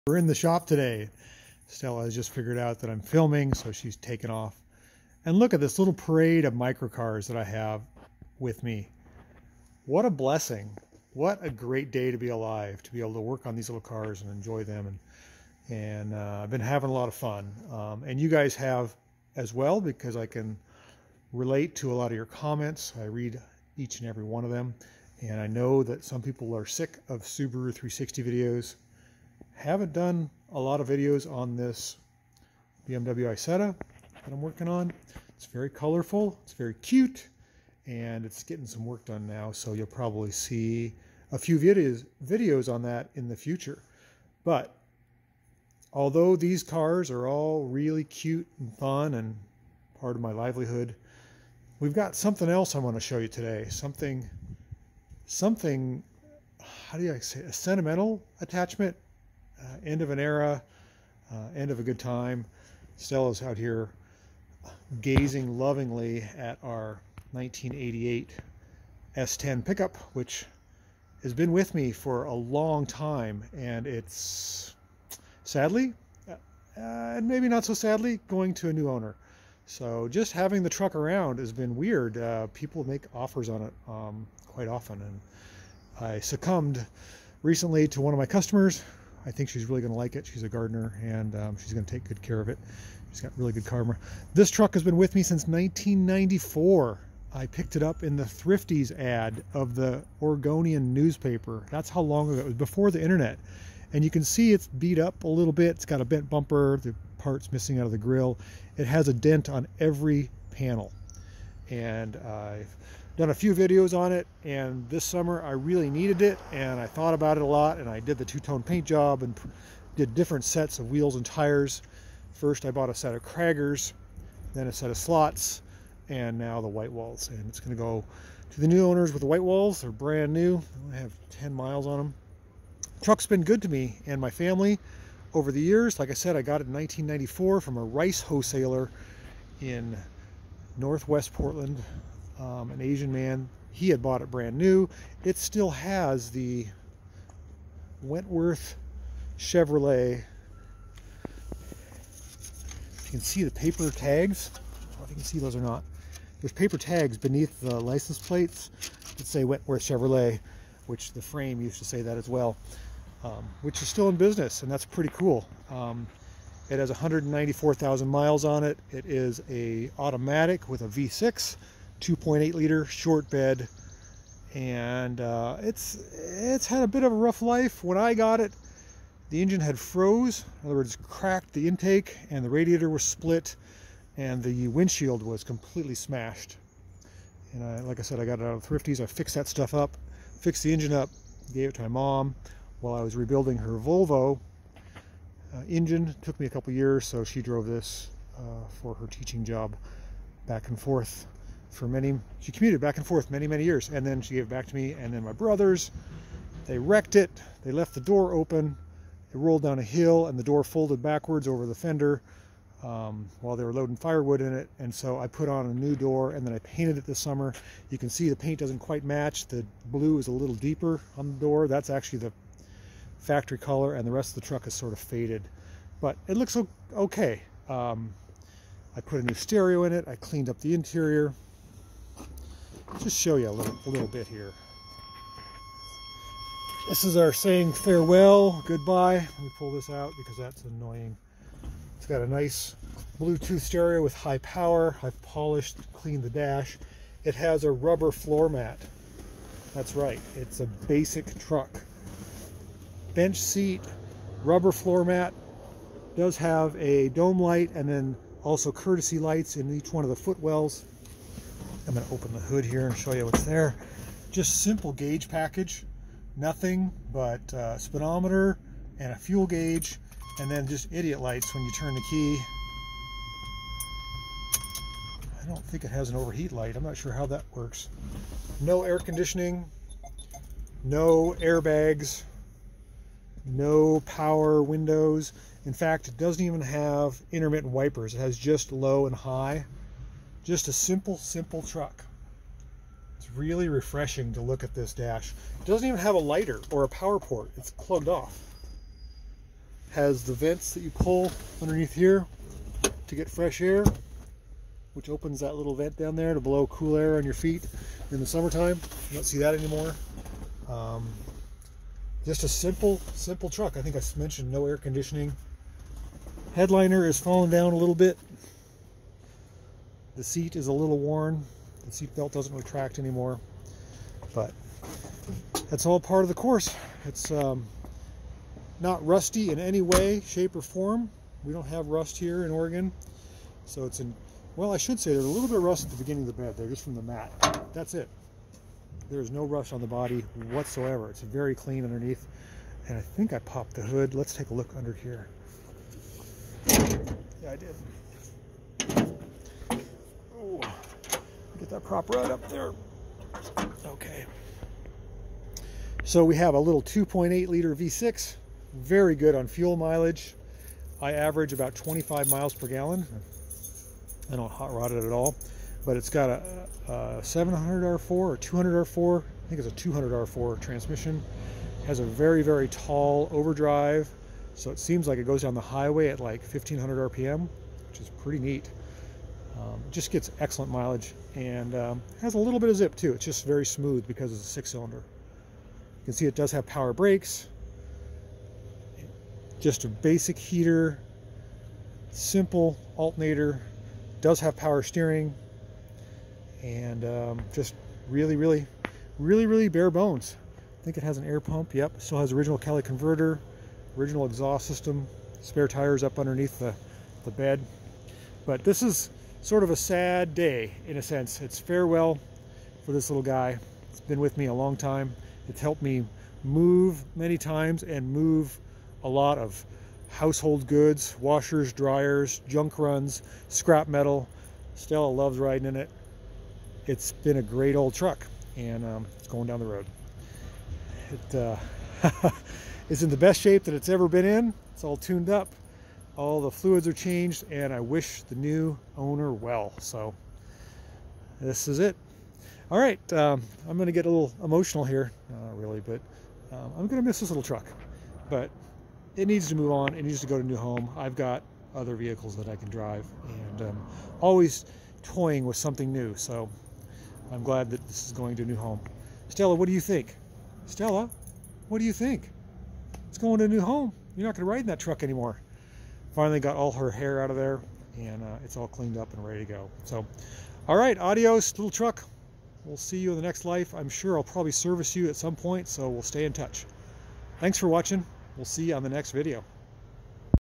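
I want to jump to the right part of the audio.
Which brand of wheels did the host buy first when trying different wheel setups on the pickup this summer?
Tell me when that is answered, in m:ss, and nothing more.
2:03.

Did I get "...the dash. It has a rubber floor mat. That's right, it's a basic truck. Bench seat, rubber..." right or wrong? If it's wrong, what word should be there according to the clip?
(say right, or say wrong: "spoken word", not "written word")
right.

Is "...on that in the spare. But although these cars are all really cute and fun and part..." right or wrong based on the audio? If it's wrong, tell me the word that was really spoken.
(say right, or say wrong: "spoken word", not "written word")
wrong: "future", not "spare".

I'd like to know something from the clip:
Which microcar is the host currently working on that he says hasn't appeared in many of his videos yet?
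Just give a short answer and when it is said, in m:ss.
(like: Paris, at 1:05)
BMW Isetta, at 0:32.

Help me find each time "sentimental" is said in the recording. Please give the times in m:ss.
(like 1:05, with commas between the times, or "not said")
0:57.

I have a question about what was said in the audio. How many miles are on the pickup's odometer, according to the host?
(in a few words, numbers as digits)
194,000.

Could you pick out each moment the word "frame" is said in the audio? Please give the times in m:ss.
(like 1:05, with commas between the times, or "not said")
2:41.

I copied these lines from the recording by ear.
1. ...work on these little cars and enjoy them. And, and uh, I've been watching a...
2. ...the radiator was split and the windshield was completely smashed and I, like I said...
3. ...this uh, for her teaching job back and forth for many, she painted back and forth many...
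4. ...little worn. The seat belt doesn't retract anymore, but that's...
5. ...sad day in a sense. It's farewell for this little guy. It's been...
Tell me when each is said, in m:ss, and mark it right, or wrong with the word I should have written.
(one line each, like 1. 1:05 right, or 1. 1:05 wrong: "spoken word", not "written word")
1. 0:13 wrong: "having", not "watching"
2. 3:02 right
3. 3:17 wrong: "commuted", not "painted"
4. 5:20 right
5. 6:49 right.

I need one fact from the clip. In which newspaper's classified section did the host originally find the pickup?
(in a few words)
The Oregonian.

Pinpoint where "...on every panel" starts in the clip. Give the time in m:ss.
1:49.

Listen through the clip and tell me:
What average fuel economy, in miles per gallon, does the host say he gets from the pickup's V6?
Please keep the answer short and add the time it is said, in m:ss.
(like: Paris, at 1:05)
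25, at 6:01.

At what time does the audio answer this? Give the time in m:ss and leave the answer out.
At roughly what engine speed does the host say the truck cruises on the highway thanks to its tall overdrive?
6:16.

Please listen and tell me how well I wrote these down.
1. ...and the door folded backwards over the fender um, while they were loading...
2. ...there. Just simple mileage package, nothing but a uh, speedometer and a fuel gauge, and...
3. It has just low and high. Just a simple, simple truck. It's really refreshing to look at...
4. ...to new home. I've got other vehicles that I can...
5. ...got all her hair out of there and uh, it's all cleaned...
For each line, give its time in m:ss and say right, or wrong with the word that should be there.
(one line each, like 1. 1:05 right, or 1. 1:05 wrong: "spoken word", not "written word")
1. 3:30 right
2. 4:23 wrong: "gauge", not "mileage"
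3. 4:48 right
4. 7:30 right
5. 7:46 right.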